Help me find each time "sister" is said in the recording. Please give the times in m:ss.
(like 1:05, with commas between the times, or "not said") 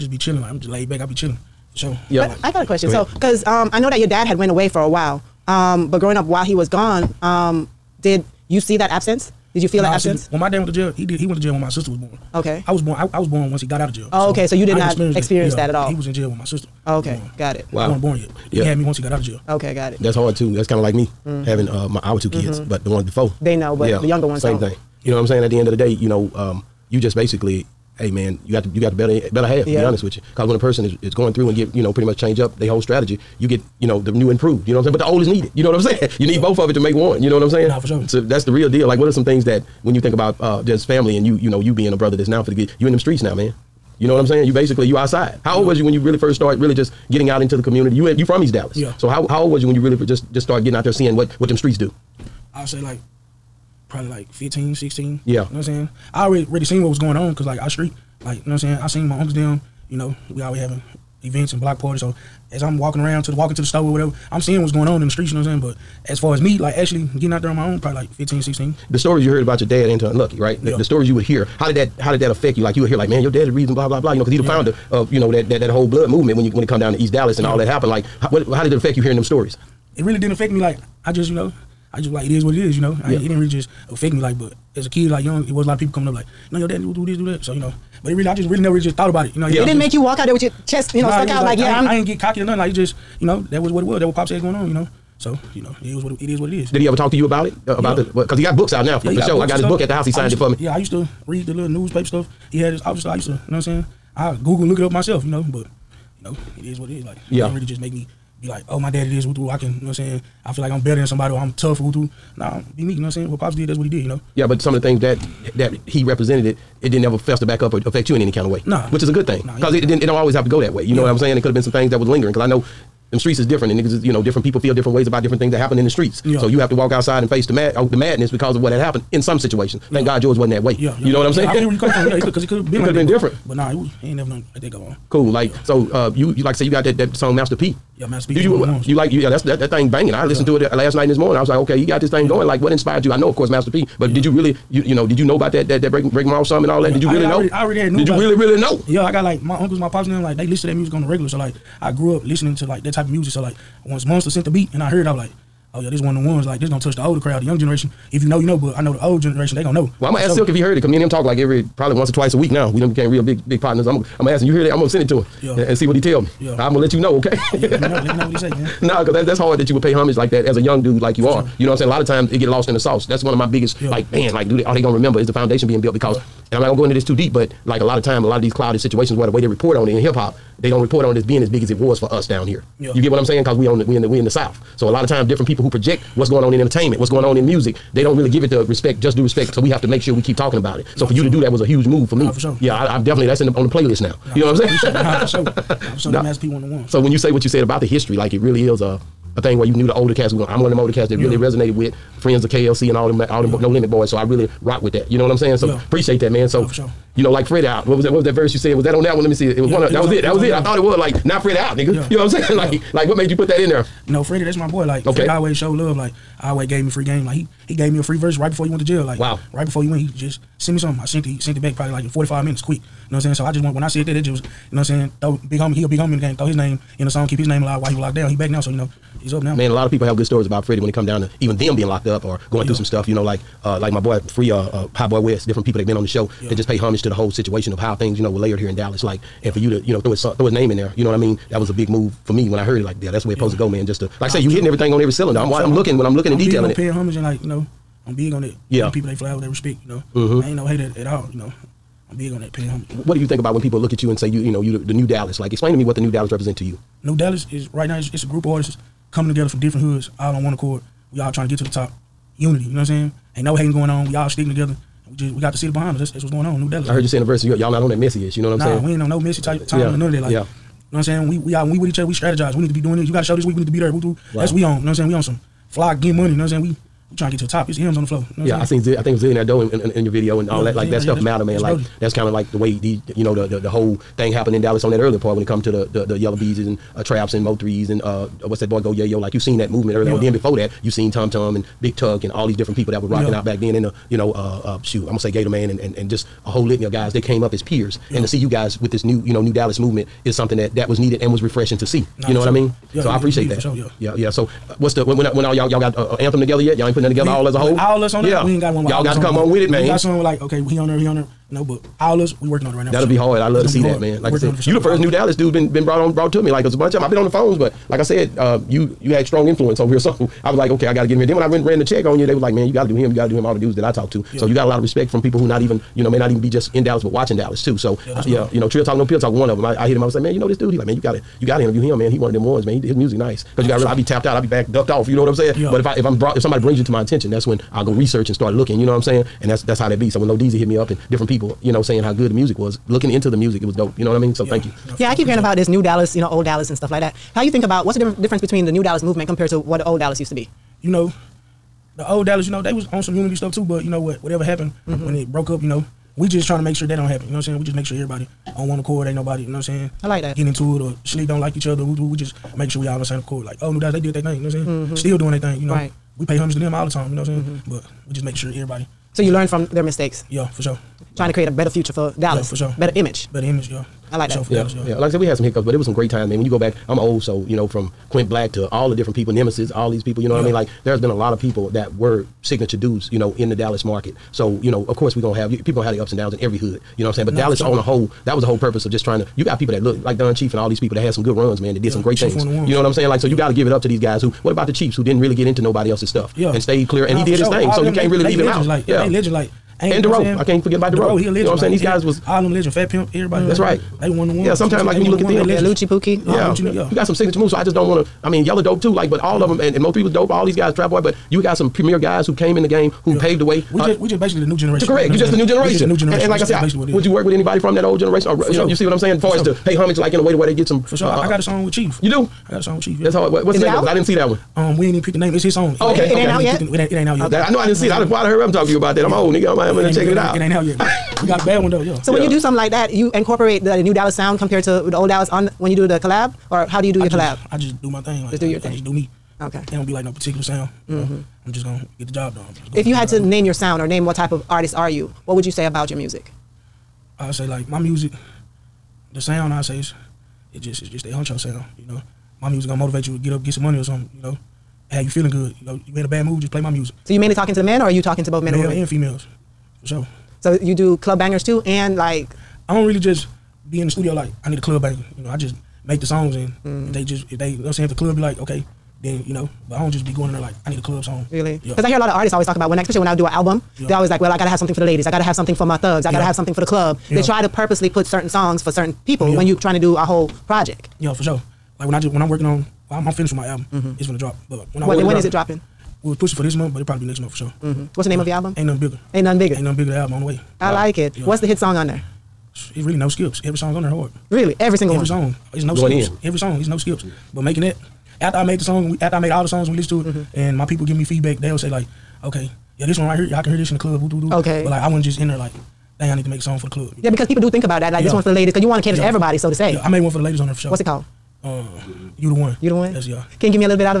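0:11, 0:16.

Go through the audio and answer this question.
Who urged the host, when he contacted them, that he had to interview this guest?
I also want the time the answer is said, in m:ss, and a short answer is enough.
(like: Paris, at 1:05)
Trill Talk No Pill Talk, at 5:28.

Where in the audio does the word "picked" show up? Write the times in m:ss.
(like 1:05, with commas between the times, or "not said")
7:05.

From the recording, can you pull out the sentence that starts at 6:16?
When you go back, I'm old, so you know from Quint Black to all the different people, Nemesis, all these people.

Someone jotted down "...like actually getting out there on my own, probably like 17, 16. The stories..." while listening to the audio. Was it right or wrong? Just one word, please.
wrong.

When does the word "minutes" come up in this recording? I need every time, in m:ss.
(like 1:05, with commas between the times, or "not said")
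3:42.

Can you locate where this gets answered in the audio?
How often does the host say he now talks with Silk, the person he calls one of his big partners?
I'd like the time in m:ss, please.
2:41.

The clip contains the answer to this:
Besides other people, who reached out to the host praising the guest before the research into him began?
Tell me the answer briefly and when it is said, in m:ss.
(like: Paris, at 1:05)
Lodizi, at 5:40.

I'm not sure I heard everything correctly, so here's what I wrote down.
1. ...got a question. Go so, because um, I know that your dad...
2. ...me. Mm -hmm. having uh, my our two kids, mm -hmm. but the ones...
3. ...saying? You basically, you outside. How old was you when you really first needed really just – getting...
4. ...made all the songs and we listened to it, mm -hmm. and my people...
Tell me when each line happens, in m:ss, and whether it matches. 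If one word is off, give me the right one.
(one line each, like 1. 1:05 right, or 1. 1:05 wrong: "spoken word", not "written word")
1. 0:02 right
2. 0:20 right
3. 0:44 wrong: "started", not "needed"
4. 8:19 right.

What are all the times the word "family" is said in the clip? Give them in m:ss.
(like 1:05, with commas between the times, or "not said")
0:40.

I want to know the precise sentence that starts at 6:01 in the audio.
We, we just making sure we all on the same accord.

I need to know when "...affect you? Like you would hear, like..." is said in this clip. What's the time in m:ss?
1:12.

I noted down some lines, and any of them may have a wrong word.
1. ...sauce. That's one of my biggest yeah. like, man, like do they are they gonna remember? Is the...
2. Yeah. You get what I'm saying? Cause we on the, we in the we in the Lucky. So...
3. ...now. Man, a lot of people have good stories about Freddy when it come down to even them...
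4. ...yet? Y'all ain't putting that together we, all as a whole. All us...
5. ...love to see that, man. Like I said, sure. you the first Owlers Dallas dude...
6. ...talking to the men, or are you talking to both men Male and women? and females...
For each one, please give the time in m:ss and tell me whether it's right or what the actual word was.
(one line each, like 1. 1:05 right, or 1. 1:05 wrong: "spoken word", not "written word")
1. 2:52 right
2. 3:02 wrong: "South", not "Lucky"
3. 3:49 right
4. 5:06 right
5. 5:13 wrong: "New", not "Owlers"
6. 7:37 right.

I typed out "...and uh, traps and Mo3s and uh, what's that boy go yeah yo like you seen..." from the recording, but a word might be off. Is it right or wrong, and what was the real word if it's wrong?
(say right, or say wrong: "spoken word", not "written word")
right.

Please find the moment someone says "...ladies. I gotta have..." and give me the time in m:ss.
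7:54.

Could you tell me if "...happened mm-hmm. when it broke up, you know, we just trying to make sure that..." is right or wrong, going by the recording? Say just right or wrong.
right.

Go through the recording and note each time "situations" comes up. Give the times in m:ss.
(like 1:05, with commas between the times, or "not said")
2:09, 2:58, 3:57.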